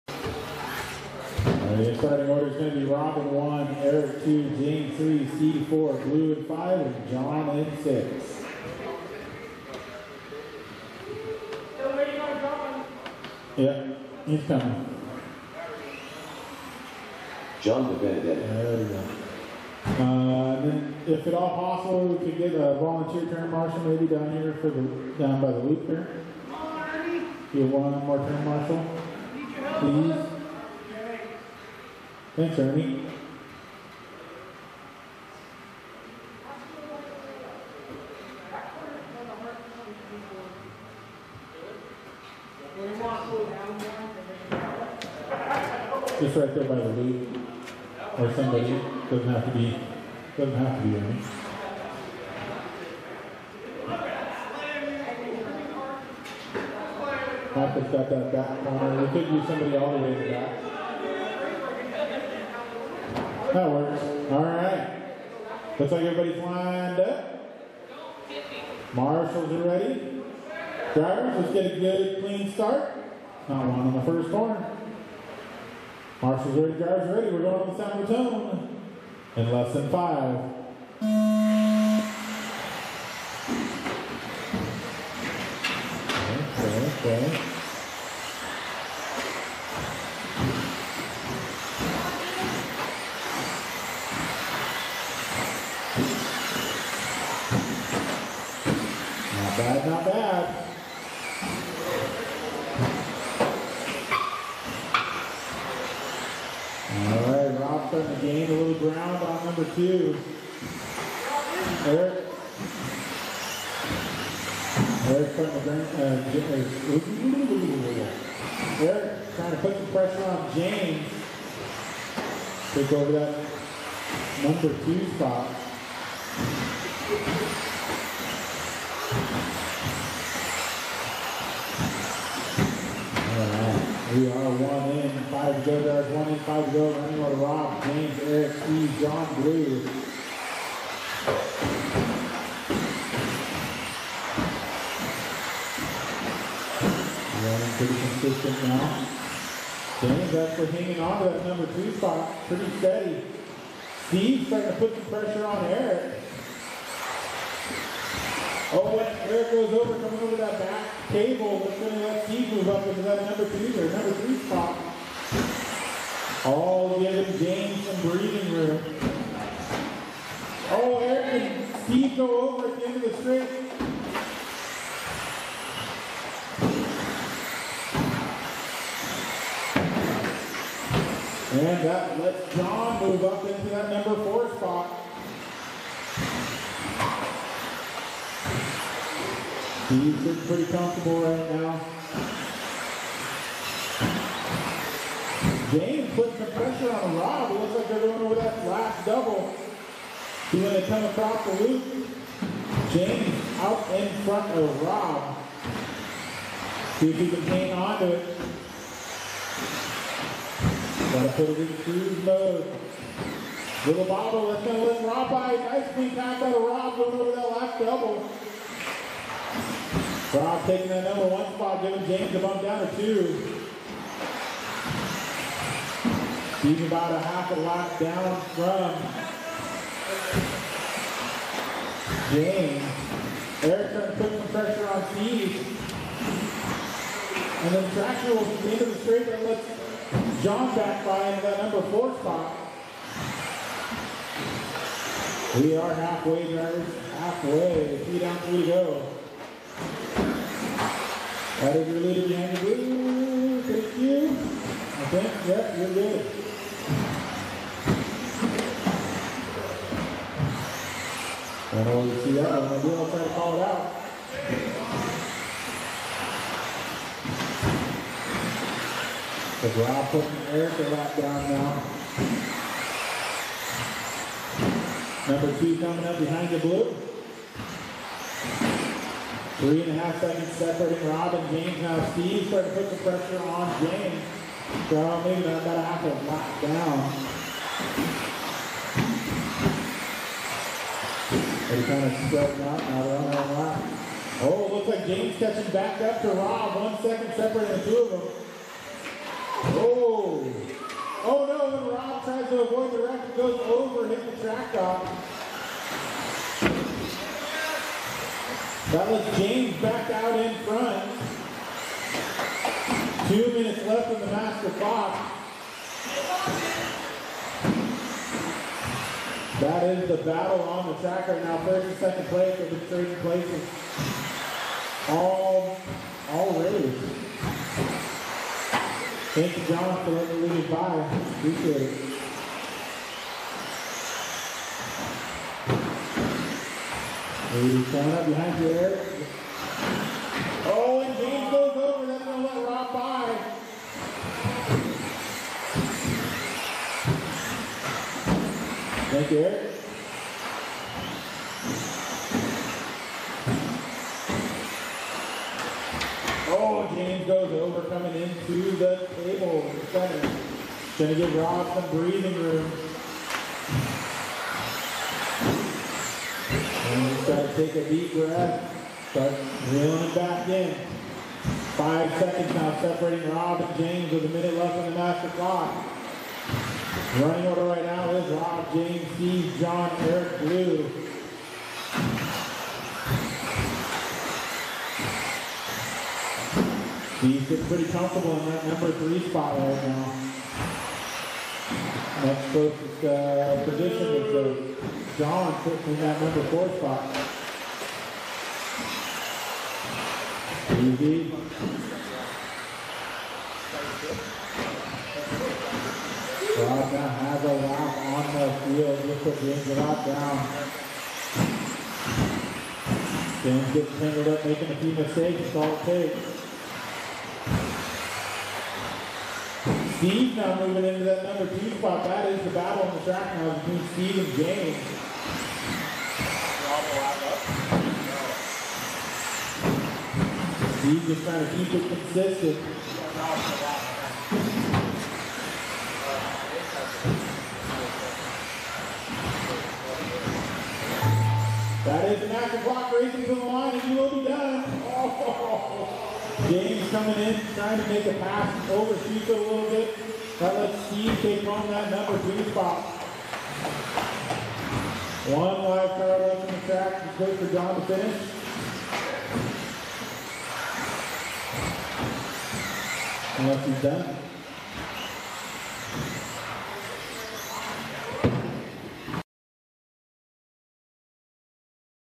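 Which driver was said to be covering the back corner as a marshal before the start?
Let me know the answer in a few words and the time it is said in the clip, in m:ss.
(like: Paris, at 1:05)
Michael, at 0:57.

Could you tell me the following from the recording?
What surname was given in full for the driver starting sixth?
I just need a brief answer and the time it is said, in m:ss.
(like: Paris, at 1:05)
DeBenedetto, at 0:17.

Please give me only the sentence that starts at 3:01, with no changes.
And that lets John move up into that number four spot.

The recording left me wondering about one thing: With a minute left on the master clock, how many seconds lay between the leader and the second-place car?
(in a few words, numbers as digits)
5.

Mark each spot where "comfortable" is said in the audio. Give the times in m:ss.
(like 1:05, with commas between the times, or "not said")
3:10, 6:27.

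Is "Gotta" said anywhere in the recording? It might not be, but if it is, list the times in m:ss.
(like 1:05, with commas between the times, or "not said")
3:31.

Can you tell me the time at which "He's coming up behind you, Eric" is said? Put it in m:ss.
5:37.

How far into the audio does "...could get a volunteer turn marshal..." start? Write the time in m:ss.
0:22.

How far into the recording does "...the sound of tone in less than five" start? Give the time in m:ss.
1:17.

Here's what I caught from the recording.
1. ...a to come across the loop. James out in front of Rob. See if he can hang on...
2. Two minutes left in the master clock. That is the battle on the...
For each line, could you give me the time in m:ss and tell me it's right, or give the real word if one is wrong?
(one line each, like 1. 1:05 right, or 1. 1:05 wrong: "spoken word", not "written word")
1. 3:20 right
2. 5:13 right.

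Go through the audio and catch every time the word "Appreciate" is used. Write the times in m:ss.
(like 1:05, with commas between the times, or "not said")
5:31.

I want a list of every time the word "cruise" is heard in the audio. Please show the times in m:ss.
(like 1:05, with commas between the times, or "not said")
3:31.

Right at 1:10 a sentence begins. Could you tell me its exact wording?
Drivers, let's get a good, clean start.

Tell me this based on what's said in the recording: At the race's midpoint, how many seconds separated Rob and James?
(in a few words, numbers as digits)
3.5.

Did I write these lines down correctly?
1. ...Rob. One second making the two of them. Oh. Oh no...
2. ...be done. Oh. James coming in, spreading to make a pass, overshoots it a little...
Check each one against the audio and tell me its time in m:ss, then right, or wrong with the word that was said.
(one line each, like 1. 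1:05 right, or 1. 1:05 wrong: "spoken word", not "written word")
1. 4:56 wrong: "separating", not "making"
2. 7:24 wrong: "trying", not "spreading".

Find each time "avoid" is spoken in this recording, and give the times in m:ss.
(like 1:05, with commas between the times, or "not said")
5:02.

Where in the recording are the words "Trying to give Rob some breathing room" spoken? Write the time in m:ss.
6:00.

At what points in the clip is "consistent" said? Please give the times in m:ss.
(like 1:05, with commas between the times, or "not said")
2:28, 7:11.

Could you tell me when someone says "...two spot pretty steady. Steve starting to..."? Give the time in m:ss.
2:31.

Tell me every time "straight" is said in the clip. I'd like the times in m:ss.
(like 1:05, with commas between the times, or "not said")
2:53, 3:59.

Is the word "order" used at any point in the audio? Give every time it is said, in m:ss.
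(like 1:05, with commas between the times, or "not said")
0:02, 6:17.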